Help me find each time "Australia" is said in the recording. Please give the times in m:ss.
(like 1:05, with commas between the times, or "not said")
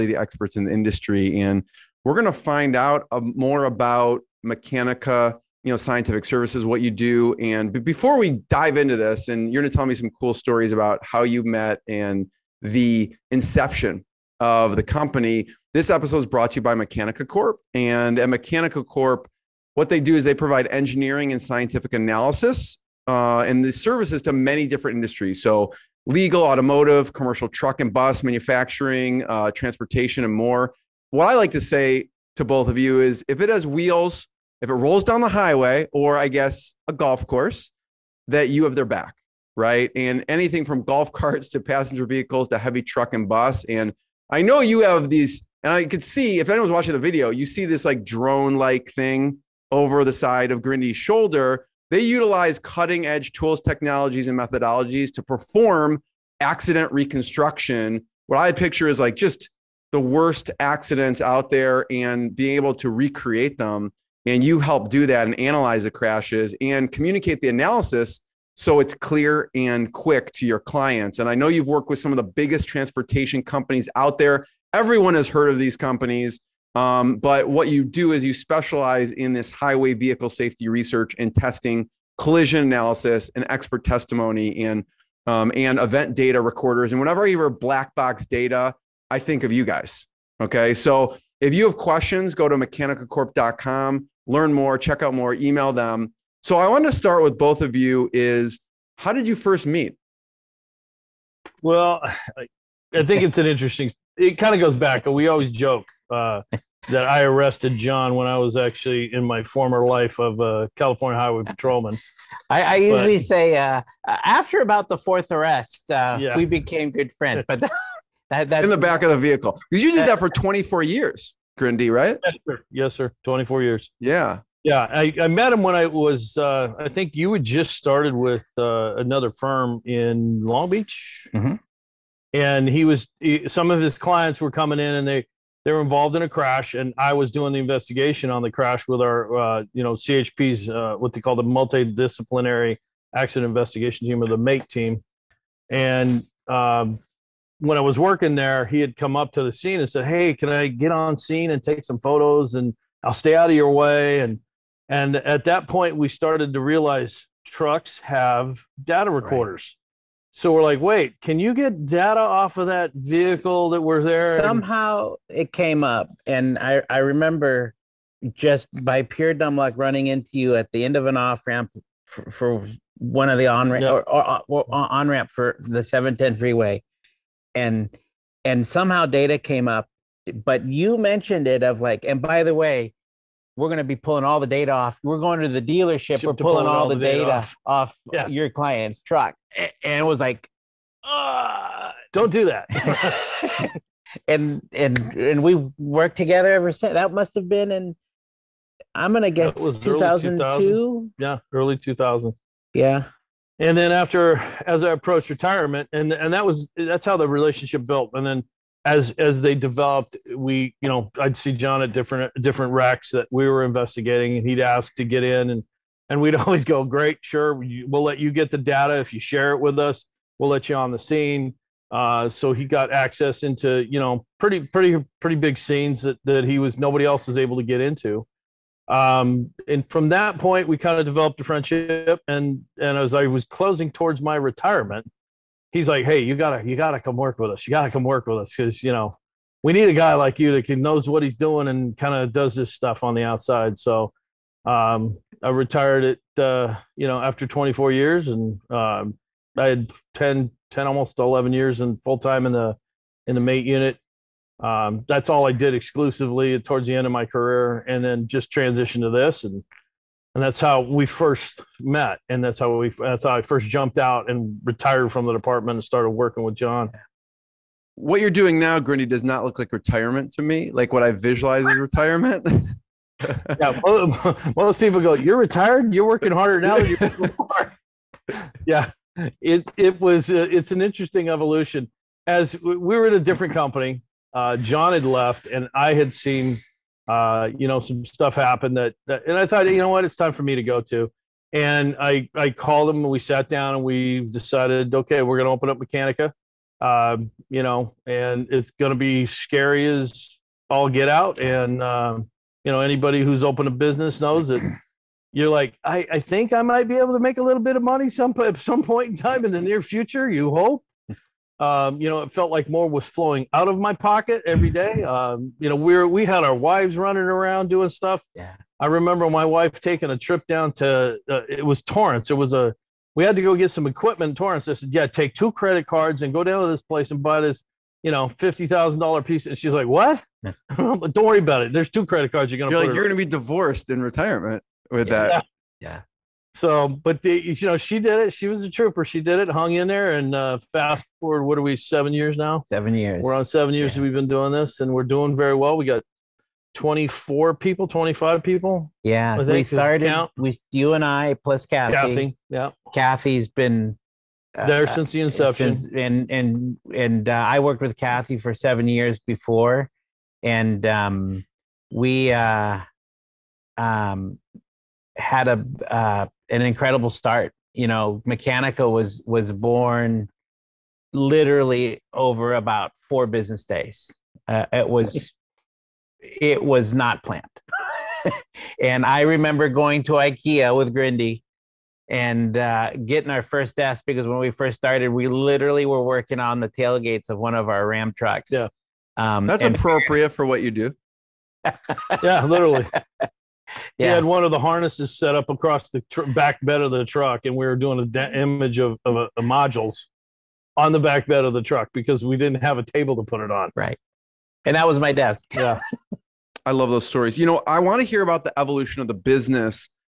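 not said.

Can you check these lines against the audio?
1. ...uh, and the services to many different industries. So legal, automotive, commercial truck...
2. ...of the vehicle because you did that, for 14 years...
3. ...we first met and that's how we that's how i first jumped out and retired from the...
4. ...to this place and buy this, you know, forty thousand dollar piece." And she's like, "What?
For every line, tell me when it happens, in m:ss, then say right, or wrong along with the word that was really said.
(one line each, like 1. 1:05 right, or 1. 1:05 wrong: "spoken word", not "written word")
1. 0:23 right
2. 1:59 wrong: "24", not "14"
3. 4:20 right
4. 5:26 wrong: "fifty", not "forty".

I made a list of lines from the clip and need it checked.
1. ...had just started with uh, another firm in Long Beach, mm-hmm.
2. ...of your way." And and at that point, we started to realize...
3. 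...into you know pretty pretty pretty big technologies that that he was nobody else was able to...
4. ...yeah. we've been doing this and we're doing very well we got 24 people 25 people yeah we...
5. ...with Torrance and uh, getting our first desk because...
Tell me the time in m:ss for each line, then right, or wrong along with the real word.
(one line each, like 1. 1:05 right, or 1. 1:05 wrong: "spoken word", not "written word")
1. 2:07 right
2. 2:33 right
3. 3:43 wrong: "scenes", not "technologies"
4. 5:43 right
5. 6:20 wrong: "Grindey", not "Torrance".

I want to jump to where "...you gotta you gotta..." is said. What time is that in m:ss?
3:56.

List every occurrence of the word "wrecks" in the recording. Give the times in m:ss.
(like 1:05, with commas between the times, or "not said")
3:32.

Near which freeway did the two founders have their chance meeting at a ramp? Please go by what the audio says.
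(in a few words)
710 freeway.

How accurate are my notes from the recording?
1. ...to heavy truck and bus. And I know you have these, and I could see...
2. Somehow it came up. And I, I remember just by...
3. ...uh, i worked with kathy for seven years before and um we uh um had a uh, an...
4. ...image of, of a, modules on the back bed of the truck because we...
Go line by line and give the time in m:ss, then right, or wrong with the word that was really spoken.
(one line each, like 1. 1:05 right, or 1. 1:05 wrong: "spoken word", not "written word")
1. 0:42 right
2. 2:44 right
3. 5:57 right
4. 6:38 right.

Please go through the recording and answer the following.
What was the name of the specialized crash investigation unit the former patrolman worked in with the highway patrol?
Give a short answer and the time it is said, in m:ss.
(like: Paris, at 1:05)
MAIT team, at 2:24.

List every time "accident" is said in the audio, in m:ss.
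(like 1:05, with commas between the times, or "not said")
0:56, 1:00, 2:23.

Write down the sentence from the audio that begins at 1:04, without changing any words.
And you help do that and analyze the crashes and communicate the analysis so it's clear and quick to your clients.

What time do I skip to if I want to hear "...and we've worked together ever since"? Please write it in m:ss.
3:15.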